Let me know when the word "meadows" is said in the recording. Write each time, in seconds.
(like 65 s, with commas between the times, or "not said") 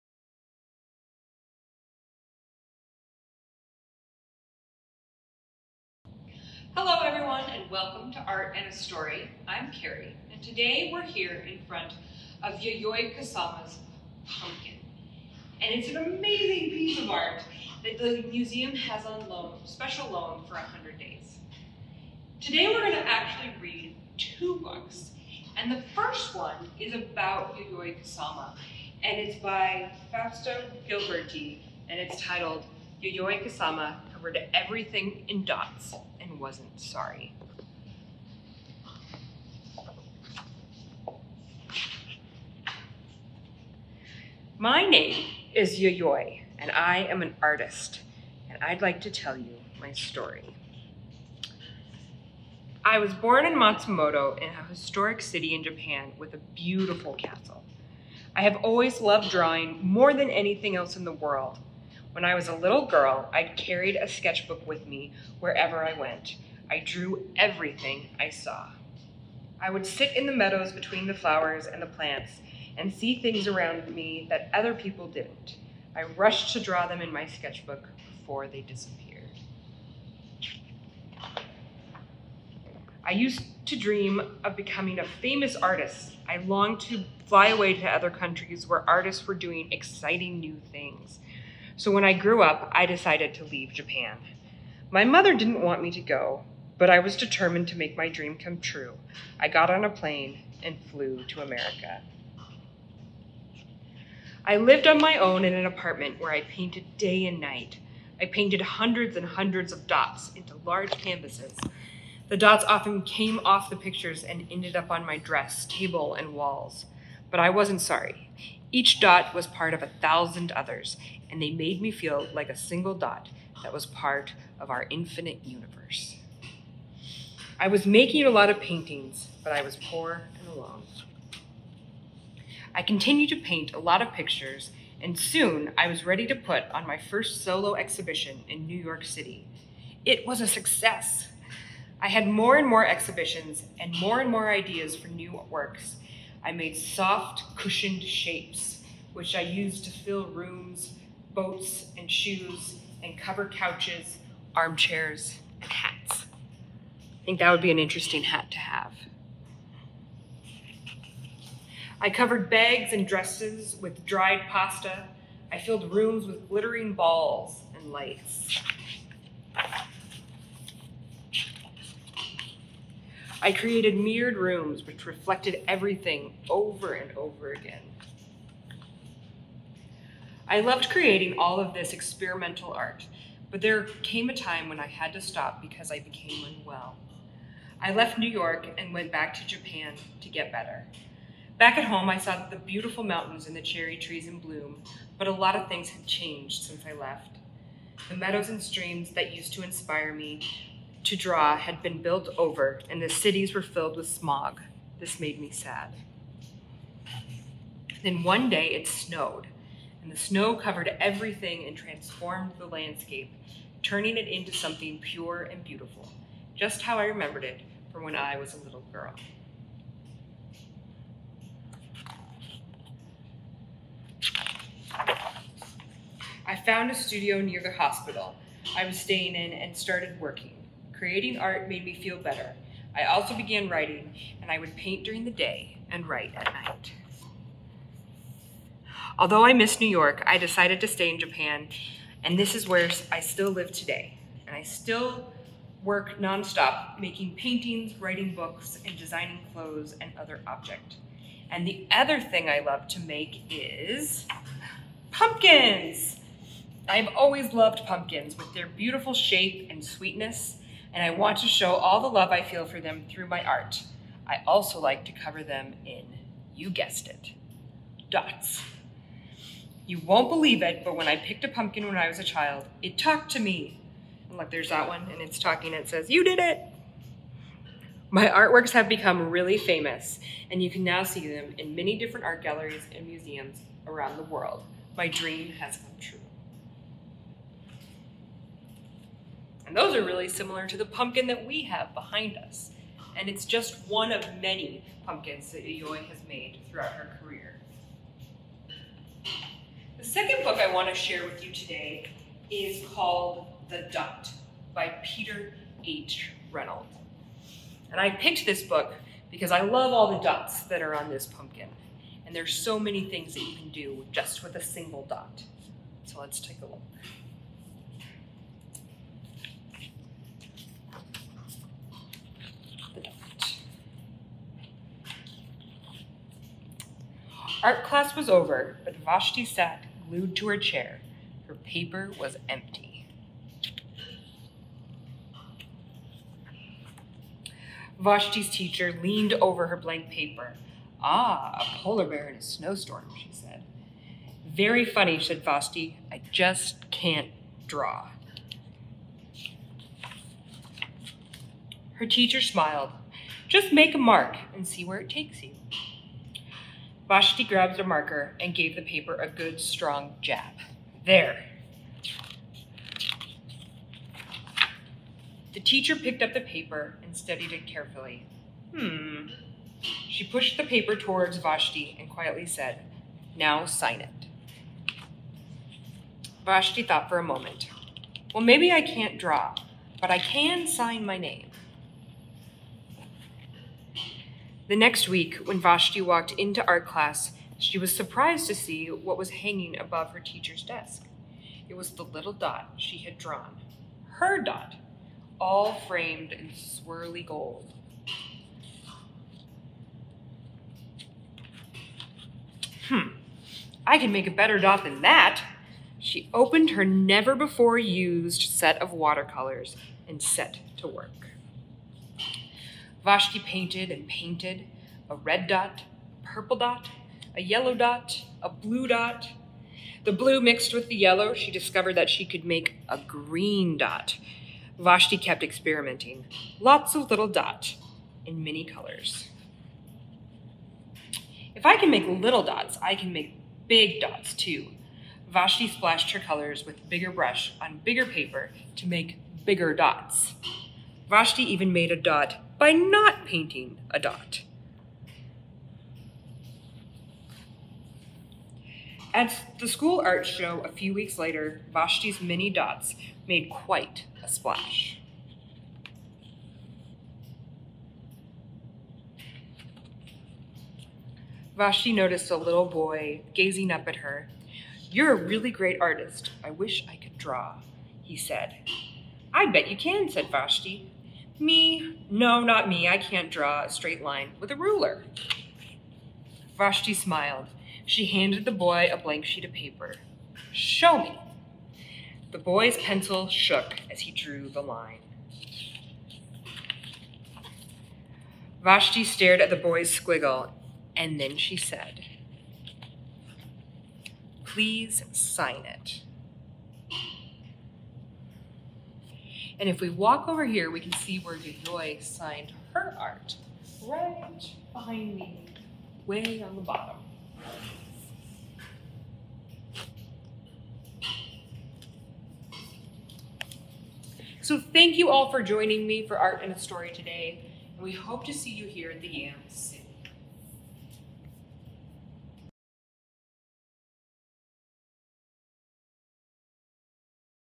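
70 s, 198 s.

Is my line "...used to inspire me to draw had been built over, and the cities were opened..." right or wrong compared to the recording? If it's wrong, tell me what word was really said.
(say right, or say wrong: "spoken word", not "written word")
wrong: "filled", not "opened".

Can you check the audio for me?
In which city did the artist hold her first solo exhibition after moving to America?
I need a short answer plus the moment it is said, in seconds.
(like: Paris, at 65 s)
New York City, at 138 s.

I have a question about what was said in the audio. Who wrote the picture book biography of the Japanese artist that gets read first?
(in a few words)
Fausto Gilberti.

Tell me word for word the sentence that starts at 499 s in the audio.
And if we walk over here, we can see where Yayoi signed her art.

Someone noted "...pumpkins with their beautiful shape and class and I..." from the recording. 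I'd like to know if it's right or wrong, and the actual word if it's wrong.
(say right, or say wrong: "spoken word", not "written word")
wrong: "sweetness", not "class".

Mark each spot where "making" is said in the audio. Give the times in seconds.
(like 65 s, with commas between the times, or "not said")
127 s, 246 s.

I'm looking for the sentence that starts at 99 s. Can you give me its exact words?
I got on a plane and flew to America.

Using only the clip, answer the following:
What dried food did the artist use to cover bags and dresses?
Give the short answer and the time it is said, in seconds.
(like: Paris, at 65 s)
Pasta, at 164 s.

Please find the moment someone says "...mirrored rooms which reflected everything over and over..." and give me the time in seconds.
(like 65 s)
173 s.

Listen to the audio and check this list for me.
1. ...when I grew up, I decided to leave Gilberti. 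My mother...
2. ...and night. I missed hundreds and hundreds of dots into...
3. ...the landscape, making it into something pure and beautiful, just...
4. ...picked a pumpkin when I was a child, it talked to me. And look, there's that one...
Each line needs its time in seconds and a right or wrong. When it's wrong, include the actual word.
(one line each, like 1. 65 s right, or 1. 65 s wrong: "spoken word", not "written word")
1. 91 s wrong: "Japan", not "Gilberti"
2. 107 s wrong: "painted", not "missed"
3. 212 s wrong: "turning", not "making"
4. 271 s right.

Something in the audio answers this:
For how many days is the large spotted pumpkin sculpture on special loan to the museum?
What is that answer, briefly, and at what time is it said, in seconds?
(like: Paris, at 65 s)
100, at 20 s.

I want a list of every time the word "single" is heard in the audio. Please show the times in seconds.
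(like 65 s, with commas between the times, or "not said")
122 s, 314 s.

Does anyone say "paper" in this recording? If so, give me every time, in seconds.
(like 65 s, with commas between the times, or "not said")
331 s, 340 s, 358 s, 366 s, 370 s, 438 s, 479 s.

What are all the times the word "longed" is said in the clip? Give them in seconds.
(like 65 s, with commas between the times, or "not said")
86 s.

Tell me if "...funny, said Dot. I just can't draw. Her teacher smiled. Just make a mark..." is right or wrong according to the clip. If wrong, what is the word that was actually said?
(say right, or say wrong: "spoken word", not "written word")
wrong: "Vashti", not "Dot".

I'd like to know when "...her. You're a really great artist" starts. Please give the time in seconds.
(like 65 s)
463 s.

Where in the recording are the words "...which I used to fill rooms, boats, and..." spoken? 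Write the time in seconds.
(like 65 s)
149 s.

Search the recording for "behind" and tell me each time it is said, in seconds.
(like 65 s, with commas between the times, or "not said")
291 s, 504 s.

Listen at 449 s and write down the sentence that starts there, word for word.
At the school art show a few weeks later, Vashti's mini dots made quite a splash.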